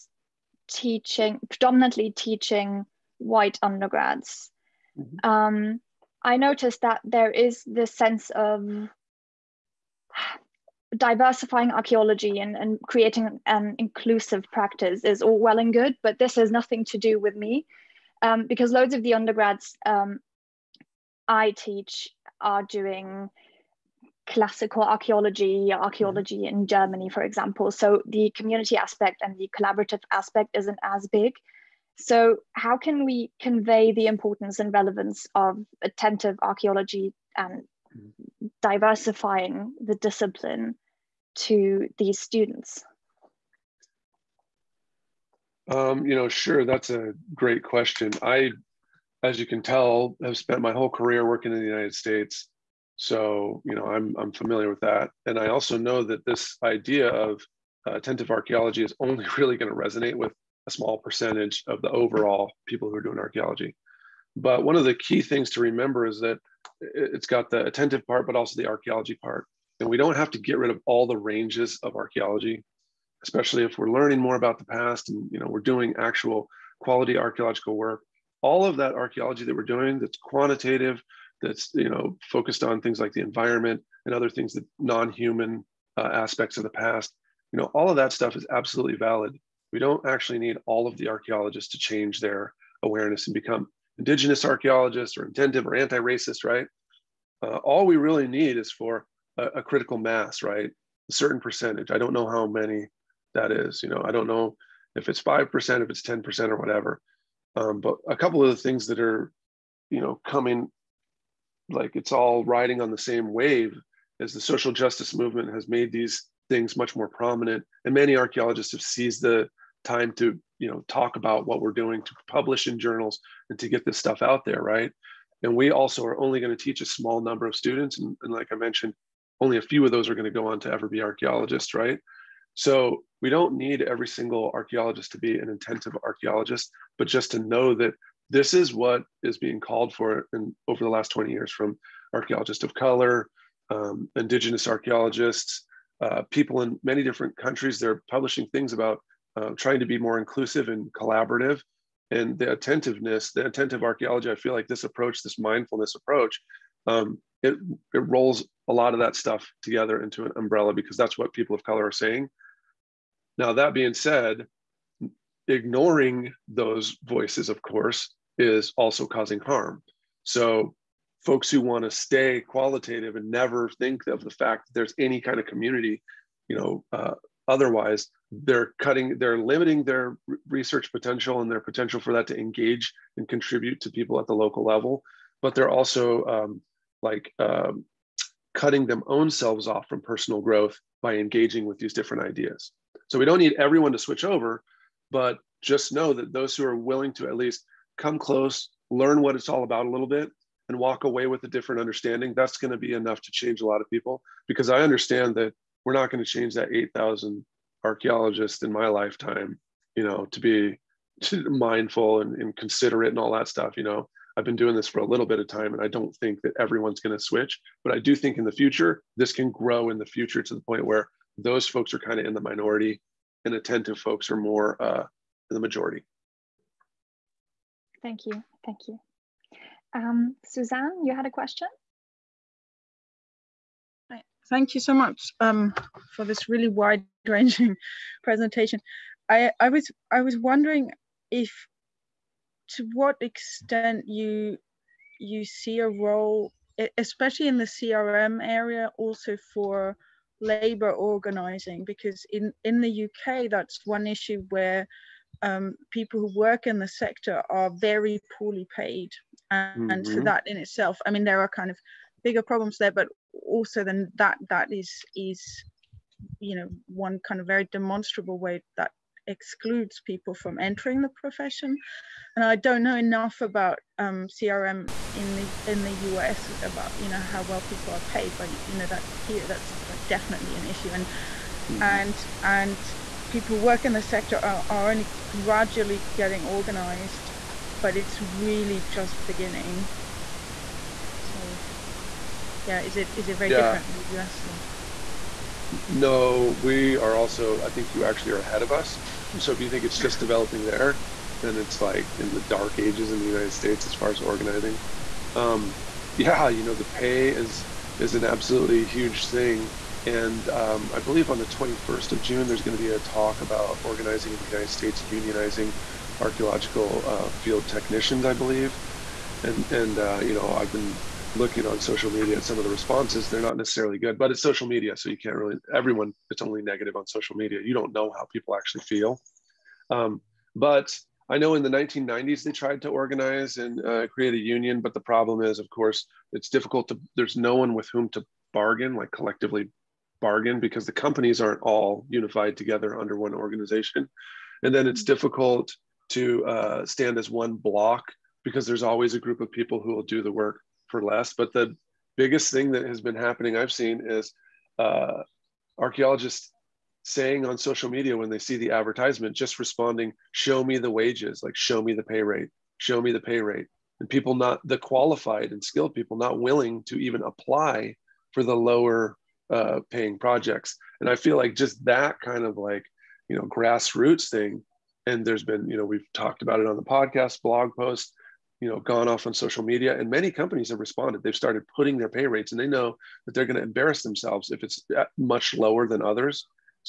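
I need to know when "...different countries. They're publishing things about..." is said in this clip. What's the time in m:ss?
2:27.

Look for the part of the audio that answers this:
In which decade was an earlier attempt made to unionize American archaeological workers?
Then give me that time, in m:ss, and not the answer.
5:31.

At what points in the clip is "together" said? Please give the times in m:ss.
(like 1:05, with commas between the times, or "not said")
2:39, 5:42.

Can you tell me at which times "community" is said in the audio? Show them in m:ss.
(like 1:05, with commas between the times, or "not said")
0:28, 2:55.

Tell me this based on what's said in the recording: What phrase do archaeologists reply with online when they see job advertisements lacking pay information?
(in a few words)
show me the wages.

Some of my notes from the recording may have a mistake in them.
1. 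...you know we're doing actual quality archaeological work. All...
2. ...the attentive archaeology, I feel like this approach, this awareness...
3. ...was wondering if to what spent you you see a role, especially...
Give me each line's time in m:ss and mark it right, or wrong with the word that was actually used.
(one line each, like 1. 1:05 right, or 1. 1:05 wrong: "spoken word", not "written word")
1. 1:15 right
2. 2:33 wrong: "mindfulness", not "awareness"
3. 4:00 wrong: "extent", not "spent".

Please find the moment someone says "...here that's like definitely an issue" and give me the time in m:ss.
4:39.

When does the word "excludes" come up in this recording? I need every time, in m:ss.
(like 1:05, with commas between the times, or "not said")
4:29.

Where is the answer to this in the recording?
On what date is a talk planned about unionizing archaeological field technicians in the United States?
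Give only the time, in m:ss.
5:11.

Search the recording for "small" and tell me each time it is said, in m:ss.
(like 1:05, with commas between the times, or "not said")
1:00, 2:06.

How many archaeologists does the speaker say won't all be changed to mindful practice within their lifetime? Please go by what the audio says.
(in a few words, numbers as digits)
8,000.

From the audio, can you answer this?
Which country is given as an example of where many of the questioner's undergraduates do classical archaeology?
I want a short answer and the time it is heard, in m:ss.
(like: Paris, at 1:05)
Germany, at 0:26.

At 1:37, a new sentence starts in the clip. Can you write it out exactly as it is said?
Uh, all we really need is for a, a critical mass, right?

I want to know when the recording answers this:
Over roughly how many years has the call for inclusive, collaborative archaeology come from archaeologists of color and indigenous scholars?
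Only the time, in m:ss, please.
2:21.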